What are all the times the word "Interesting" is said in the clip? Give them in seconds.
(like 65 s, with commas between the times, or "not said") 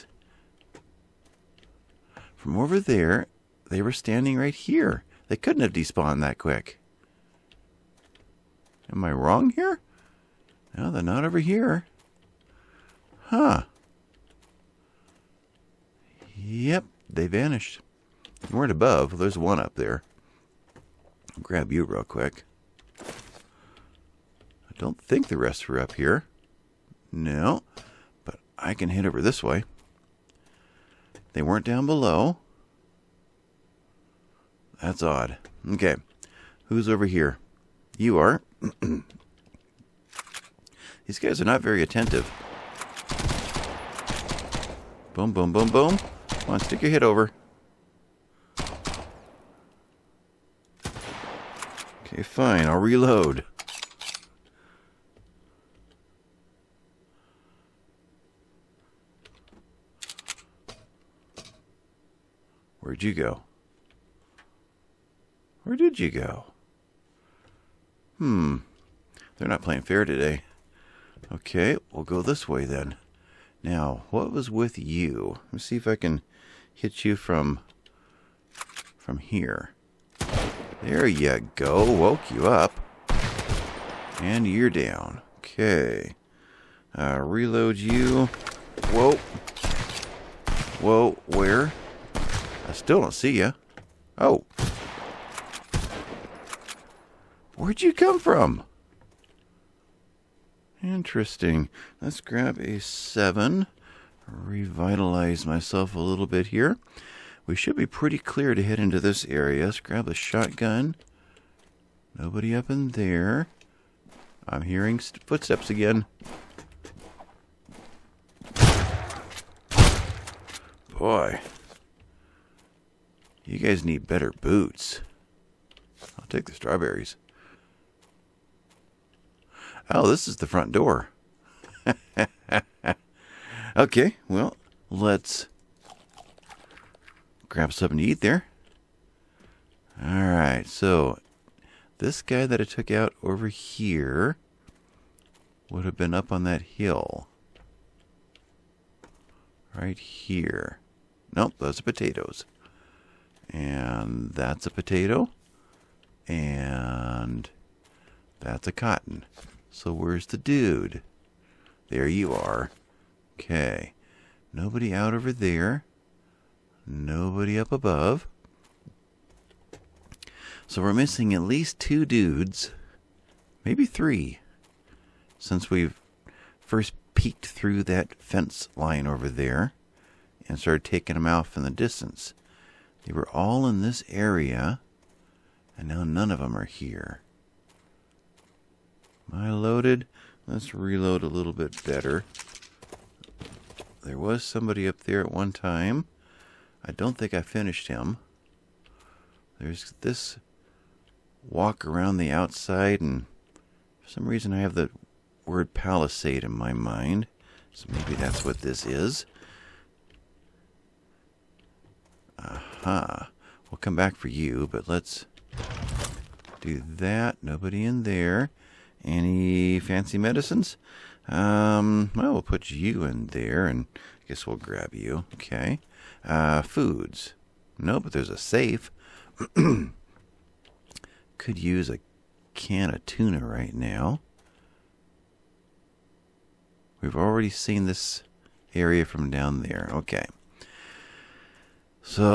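100 s.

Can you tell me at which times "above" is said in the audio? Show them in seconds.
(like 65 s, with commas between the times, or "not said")
18 s, 167 s.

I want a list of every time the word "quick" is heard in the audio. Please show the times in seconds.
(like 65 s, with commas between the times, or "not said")
6 s, 22 s.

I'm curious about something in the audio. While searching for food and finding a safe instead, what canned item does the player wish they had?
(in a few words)
tuna.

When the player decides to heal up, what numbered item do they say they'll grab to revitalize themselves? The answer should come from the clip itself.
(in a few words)
7.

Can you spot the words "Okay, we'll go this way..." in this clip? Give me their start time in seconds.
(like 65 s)
71 s.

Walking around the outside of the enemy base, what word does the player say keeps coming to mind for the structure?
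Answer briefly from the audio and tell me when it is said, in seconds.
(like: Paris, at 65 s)
palisade, at 205 s.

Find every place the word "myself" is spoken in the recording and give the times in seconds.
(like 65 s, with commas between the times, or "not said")
105 s.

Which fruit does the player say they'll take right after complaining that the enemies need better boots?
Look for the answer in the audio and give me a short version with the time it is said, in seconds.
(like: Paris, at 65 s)
strawberries, at 126 s.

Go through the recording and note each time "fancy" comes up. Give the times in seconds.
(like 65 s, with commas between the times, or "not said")
219 s.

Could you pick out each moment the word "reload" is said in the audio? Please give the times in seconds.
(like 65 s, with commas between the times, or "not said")
52 s, 87 s, 190 s.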